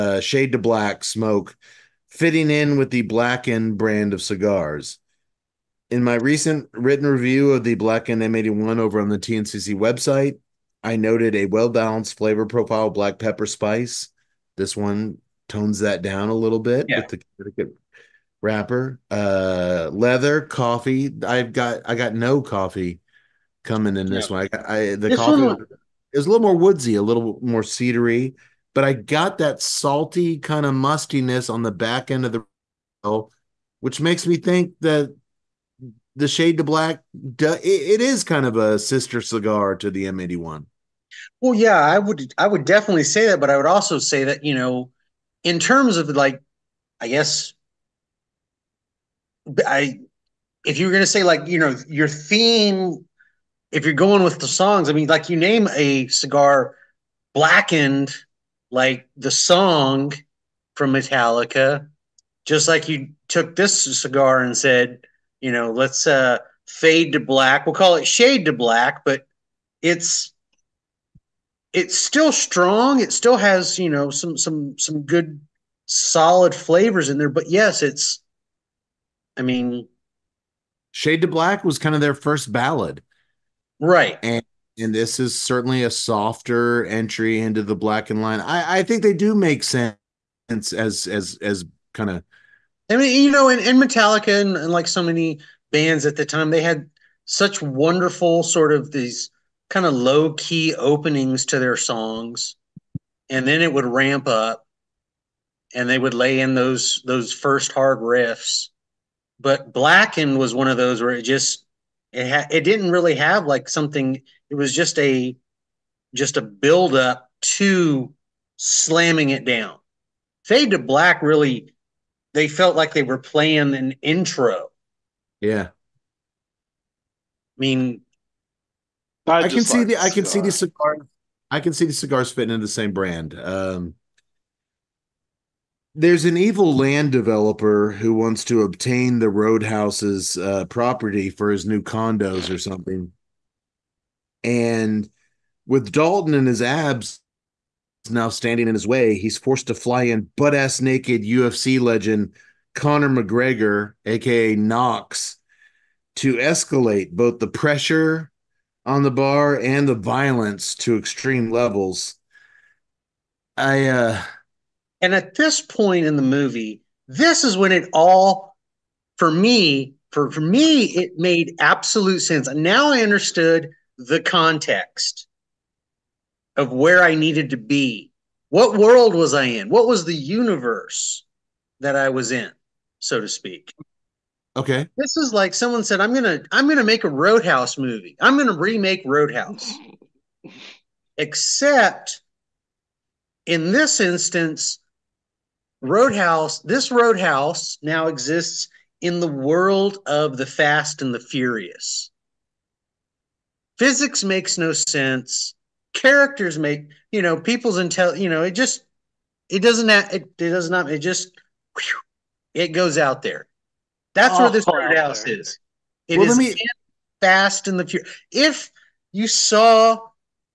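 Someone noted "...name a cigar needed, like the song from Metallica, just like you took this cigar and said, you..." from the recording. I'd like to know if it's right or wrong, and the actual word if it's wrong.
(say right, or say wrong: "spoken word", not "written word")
wrong: "blackened", not "needed".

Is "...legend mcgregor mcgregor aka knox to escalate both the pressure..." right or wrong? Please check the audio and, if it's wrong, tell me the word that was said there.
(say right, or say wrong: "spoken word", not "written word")
wrong: "conor", not "mcgregor".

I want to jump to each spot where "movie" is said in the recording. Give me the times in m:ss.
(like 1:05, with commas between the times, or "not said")
2:46, 3:07.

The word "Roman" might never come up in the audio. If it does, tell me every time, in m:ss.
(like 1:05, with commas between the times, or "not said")
not said.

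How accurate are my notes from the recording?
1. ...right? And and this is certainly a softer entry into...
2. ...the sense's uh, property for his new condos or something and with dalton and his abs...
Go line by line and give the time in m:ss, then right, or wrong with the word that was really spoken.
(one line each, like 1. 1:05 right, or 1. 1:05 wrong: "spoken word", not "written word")
1. 1:23 right
2. 2:19 wrong: "roadhouse", not "sense".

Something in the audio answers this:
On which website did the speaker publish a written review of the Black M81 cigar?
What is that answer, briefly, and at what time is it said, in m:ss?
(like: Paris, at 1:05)
TNCC, at 0:09.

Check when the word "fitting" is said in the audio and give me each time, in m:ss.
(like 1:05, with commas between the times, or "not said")
0:02, 2:12.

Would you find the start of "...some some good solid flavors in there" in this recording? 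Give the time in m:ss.
1:14.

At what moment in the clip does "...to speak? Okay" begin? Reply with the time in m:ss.
3:03.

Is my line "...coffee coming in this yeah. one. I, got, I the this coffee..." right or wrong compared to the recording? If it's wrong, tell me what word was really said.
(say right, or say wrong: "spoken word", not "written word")
right.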